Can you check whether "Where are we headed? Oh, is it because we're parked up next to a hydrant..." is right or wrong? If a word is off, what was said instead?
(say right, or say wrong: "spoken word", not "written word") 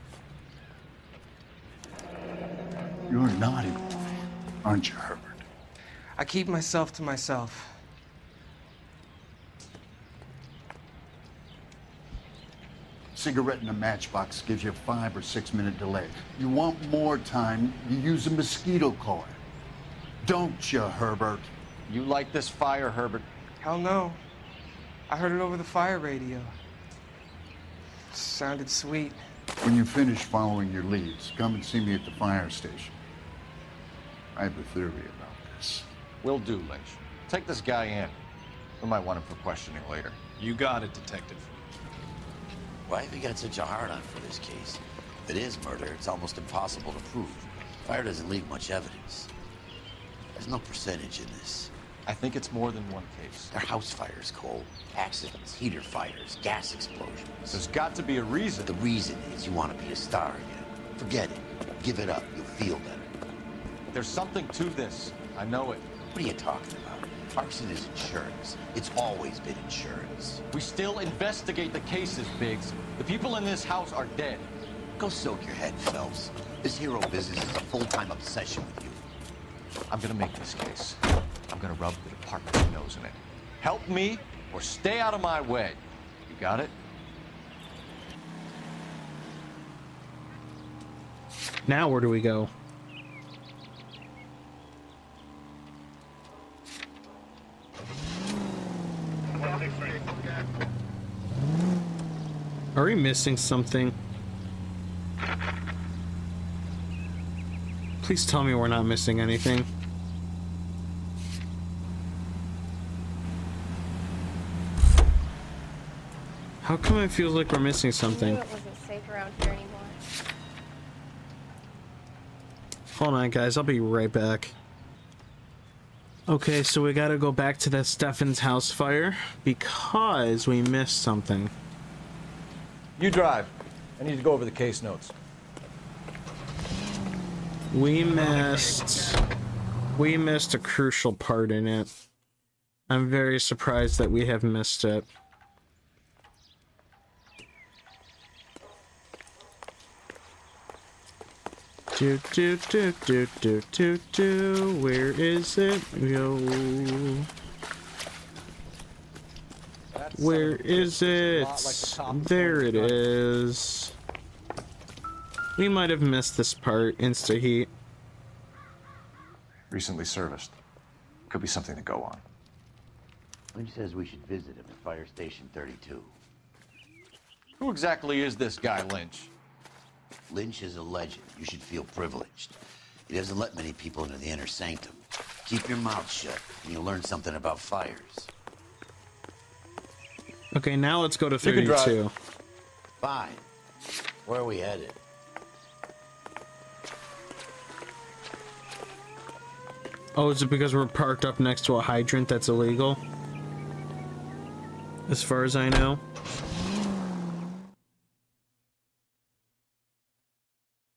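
right.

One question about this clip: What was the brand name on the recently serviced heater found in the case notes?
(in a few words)
Insta heat.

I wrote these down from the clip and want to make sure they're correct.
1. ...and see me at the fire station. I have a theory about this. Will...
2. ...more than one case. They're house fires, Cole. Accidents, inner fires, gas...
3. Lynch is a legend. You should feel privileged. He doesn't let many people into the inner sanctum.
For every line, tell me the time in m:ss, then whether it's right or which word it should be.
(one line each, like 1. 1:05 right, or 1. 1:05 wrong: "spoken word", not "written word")
1. 0:31 right
2. 0:52 wrong: "heater", not "inner"
3. 3:00 right.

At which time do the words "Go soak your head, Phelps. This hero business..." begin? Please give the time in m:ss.
1:14.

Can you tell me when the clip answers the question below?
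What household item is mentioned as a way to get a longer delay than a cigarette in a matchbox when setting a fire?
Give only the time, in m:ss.
0:18.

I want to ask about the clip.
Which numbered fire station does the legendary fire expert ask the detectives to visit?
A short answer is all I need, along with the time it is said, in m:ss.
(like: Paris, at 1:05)
Fire Station 32, at 2:54.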